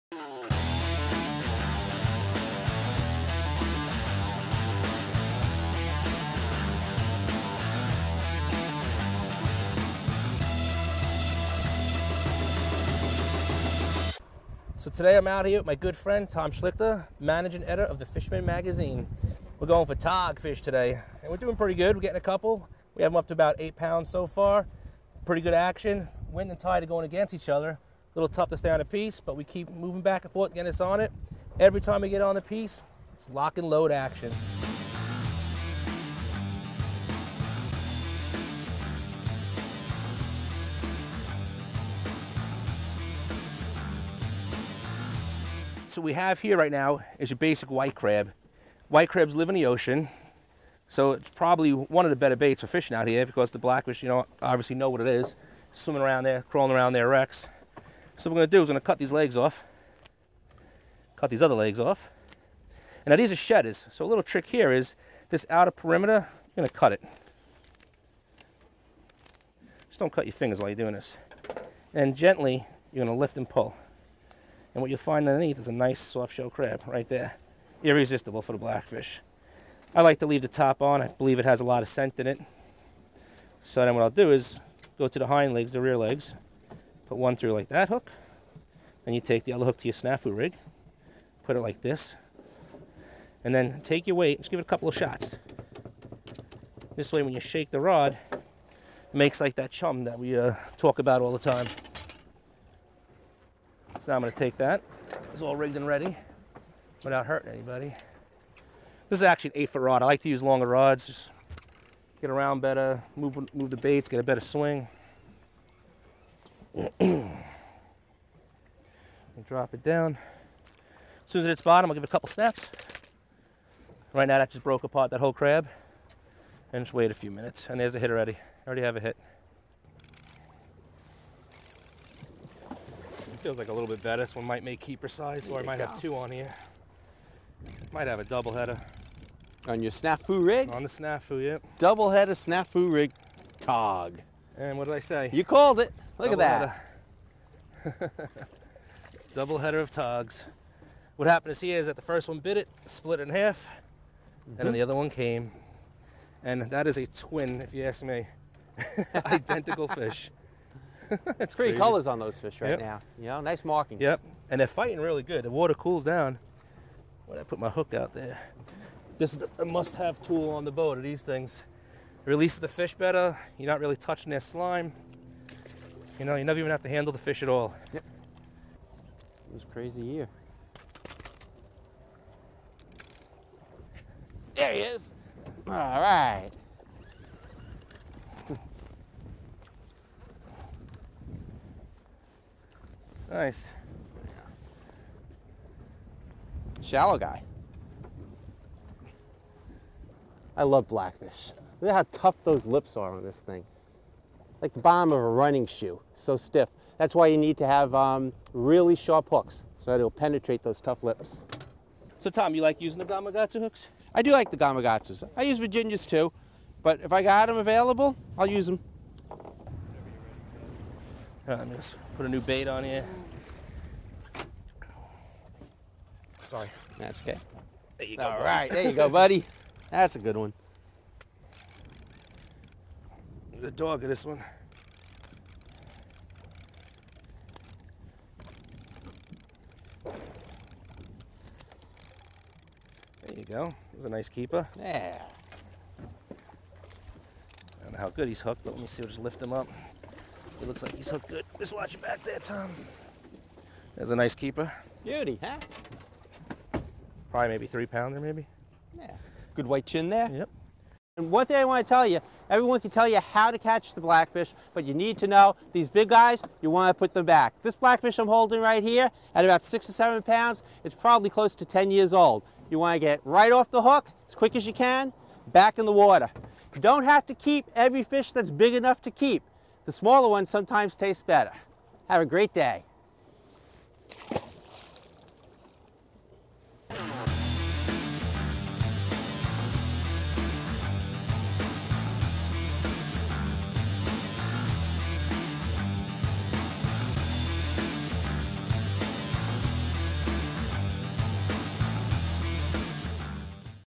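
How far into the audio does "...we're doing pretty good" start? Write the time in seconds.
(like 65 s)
21 s.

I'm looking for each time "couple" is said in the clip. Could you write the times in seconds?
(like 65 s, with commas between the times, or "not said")
22 s, 94 s, 122 s.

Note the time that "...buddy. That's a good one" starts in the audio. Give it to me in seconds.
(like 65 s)
229 s.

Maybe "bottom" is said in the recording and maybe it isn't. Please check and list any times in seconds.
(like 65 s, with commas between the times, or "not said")
121 s, 204 s.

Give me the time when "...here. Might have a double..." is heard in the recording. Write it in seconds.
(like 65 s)
136 s.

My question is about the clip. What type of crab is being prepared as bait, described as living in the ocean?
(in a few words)
White crab.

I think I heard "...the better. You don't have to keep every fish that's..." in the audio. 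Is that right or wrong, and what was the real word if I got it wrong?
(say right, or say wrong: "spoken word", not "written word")
wrong: "water", not "better".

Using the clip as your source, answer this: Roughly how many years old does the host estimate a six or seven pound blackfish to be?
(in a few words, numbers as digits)
10 years.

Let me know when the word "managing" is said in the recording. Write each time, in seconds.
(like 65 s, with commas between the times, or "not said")
17 s.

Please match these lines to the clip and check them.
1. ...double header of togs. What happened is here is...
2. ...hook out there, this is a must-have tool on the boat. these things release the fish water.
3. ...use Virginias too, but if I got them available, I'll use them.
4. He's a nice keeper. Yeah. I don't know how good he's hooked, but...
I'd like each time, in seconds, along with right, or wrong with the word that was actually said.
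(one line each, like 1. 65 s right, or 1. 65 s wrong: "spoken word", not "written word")
1. 149 s right
2. 167 s wrong: "better", not "water"
3. 215 s right
4. 243 s right.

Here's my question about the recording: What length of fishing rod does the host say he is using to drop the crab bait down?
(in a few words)
8 feet.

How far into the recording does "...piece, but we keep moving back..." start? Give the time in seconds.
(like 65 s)
28 s.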